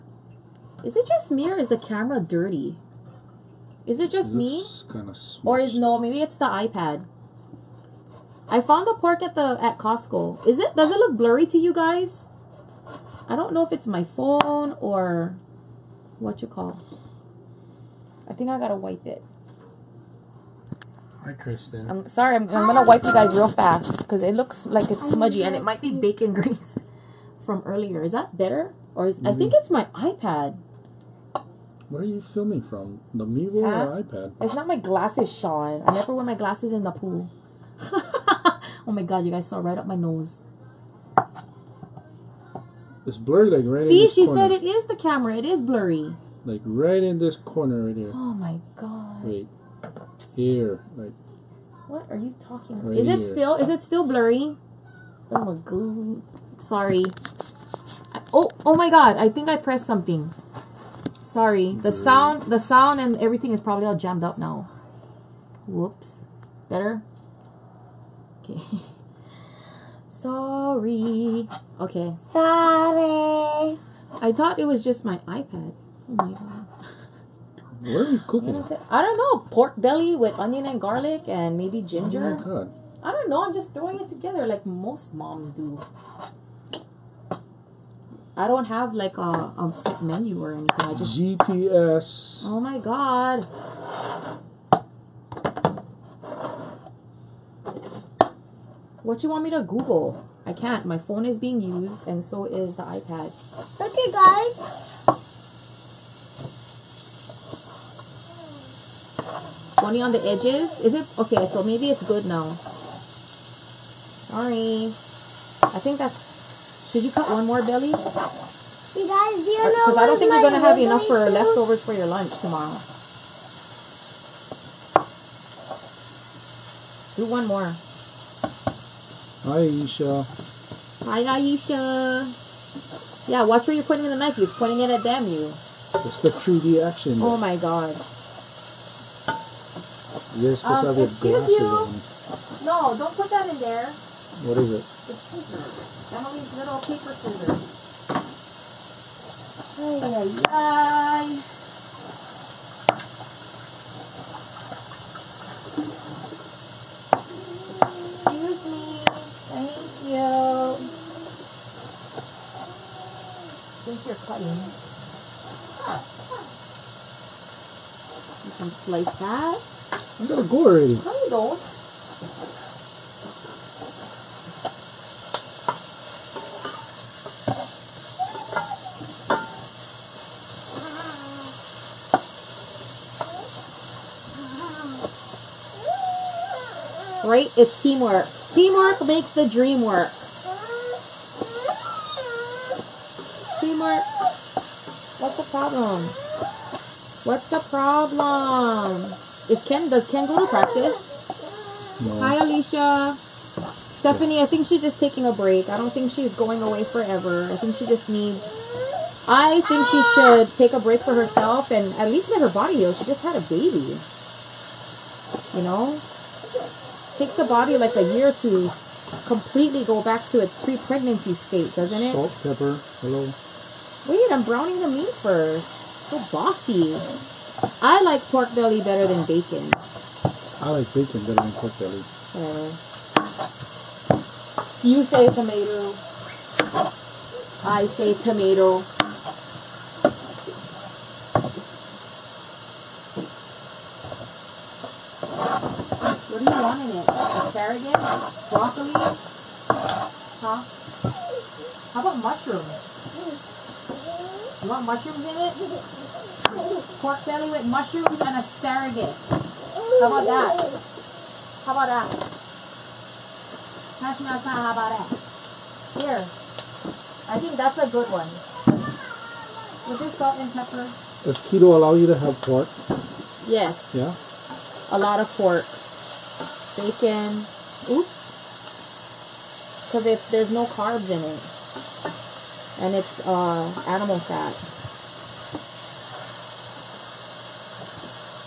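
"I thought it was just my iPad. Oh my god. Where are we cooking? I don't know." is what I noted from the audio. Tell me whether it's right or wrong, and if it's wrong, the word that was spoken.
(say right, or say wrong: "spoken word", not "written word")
right.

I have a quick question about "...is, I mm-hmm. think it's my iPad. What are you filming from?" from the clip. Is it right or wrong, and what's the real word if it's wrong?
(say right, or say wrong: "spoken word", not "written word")
right.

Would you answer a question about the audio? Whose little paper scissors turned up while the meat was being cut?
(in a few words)
Emily's.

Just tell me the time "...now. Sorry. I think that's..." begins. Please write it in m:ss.
1:52.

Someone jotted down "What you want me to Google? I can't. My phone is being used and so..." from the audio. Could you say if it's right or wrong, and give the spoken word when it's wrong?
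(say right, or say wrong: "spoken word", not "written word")
right.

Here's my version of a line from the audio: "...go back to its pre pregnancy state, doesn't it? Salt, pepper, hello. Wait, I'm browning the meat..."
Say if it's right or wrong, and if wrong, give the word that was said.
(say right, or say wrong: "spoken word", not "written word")
right.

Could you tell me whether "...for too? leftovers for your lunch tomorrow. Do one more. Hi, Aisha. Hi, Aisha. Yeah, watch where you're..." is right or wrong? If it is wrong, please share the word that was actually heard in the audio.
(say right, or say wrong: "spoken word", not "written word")
right.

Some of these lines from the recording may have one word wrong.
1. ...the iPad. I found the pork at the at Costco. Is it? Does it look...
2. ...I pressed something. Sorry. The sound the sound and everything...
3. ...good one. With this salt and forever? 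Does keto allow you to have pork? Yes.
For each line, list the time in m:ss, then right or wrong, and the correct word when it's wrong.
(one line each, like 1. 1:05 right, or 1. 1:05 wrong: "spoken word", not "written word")
1. 0:06 right
2. 0:59 right
3. 4:27 wrong: "pepper", not "forever".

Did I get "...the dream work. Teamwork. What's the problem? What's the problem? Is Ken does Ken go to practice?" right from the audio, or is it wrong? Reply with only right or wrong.
right.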